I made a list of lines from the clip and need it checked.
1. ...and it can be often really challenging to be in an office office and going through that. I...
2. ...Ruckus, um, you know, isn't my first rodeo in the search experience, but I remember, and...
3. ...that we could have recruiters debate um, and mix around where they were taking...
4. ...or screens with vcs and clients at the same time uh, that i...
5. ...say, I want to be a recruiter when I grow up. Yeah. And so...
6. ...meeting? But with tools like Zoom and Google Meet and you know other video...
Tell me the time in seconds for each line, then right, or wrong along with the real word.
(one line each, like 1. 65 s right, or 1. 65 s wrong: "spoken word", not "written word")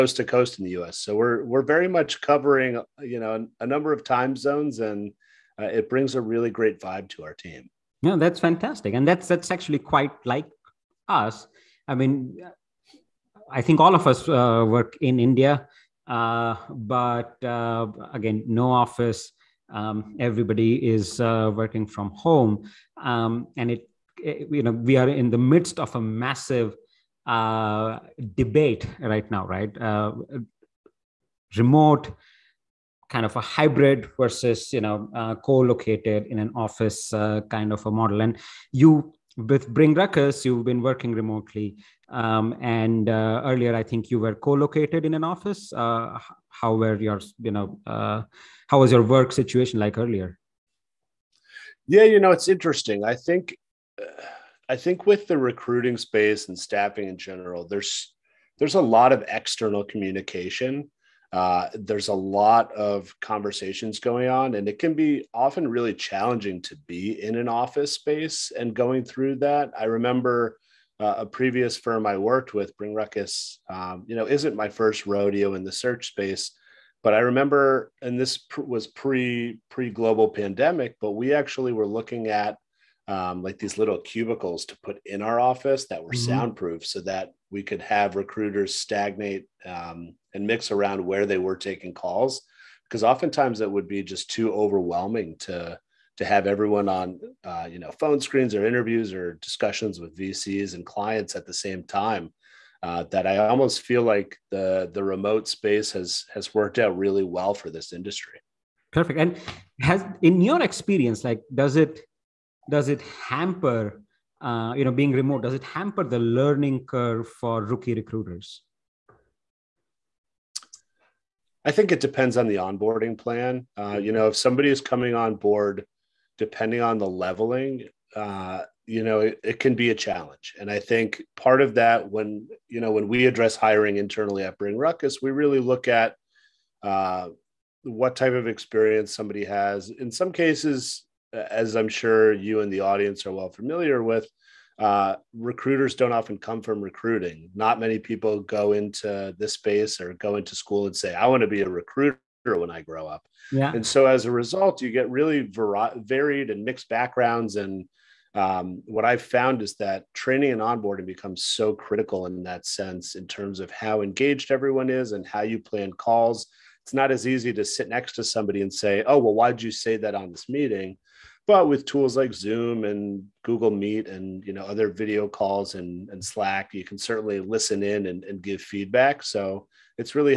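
1. 64 s wrong: "space", not "office"
2. 72 s wrong: "space", not "experience"
3. 87 s wrong: "stagnate", not "debate"
4. 99 s wrong: "discussions", not "screens"
5. 150 s right
6. 170 s right.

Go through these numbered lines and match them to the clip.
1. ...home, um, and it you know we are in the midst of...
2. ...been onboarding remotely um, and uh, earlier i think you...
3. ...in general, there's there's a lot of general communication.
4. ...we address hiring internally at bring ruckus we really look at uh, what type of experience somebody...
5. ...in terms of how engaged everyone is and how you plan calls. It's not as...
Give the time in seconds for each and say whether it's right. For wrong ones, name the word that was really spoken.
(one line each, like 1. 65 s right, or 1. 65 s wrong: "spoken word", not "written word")
1. 22 s right
2. 40 s wrong: "working", not "onboarding"
3. 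57 s wrong: "external", not "general"
4. 133 s right
5. 163 s right.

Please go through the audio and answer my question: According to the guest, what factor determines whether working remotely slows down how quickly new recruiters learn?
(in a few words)
the onboarding plan.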